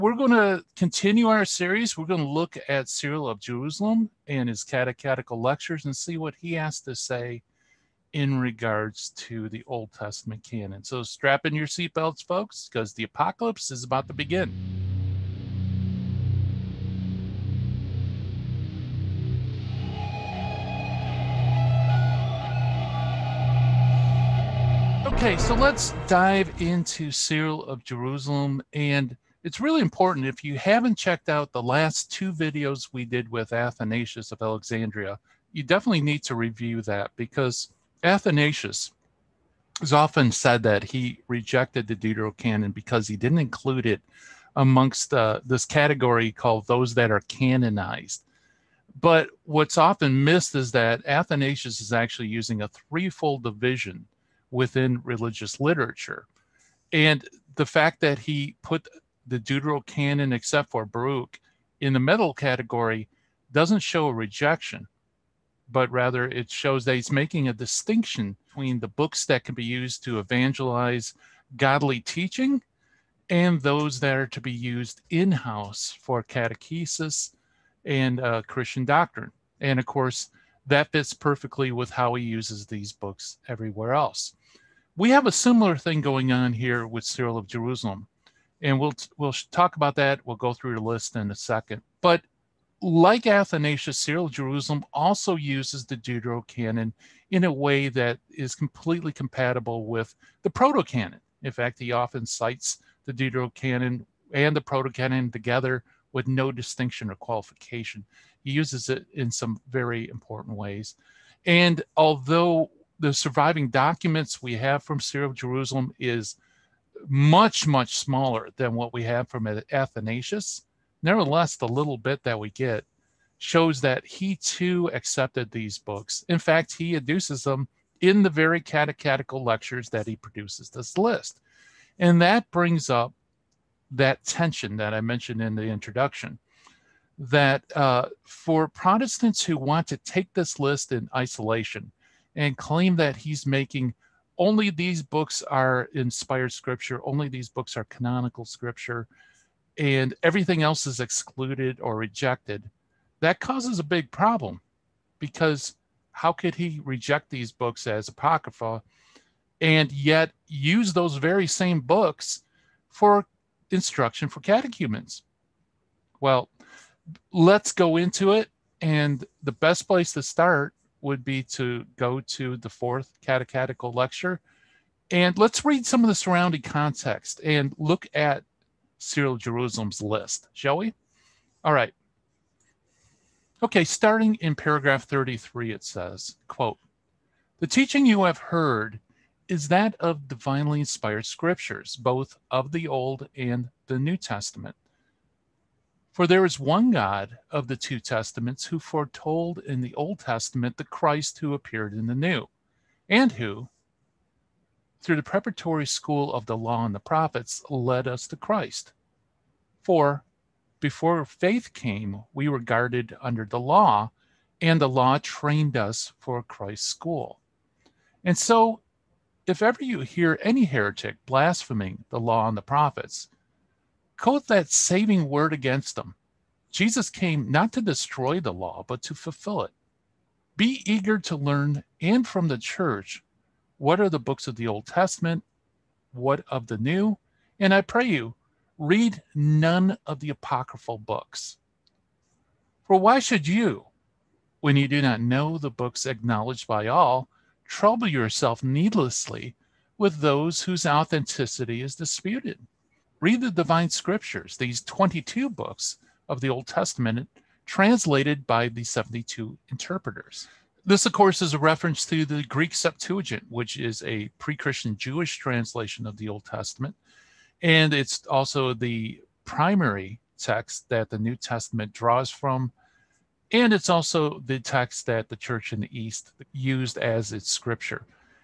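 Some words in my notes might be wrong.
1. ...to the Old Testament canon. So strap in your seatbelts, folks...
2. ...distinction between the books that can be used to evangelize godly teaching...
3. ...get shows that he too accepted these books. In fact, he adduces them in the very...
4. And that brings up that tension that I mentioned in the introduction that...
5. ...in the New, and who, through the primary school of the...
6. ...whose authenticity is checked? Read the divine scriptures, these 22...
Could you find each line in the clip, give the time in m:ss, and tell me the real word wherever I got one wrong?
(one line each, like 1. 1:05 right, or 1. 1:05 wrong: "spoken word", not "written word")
1. 0:09 right
2. 1:07 right
3. 2:02 right
4. 2:12 right
5. 3:21 wrong: "preparatory", not "primary"
6. 4:10 wrong: "disputed", not "checked".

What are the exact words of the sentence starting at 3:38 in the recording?
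And so, if ever you hear any heretic blaspheming the law and the prophets, quote that saving word against them.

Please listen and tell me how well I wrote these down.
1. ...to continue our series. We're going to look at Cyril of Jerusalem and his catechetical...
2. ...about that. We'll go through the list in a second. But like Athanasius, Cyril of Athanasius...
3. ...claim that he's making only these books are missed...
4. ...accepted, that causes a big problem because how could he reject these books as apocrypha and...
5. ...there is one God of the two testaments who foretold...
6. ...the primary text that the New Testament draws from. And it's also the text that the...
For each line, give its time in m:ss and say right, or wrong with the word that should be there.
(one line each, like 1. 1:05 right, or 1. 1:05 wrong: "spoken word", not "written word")
1. 0:00 right
2. 1:29 wrong: "Jerusalem", not "Athanasius"
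3. 2:22 wrong: "inspired", not "missed"
4. 2:31 wrong: "rejected", not "accepted"
5. 3:16 right
6. 4:28 right.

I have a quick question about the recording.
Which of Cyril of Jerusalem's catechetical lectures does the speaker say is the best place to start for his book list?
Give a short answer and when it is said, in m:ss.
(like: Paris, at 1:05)
The fourth, at 2:52.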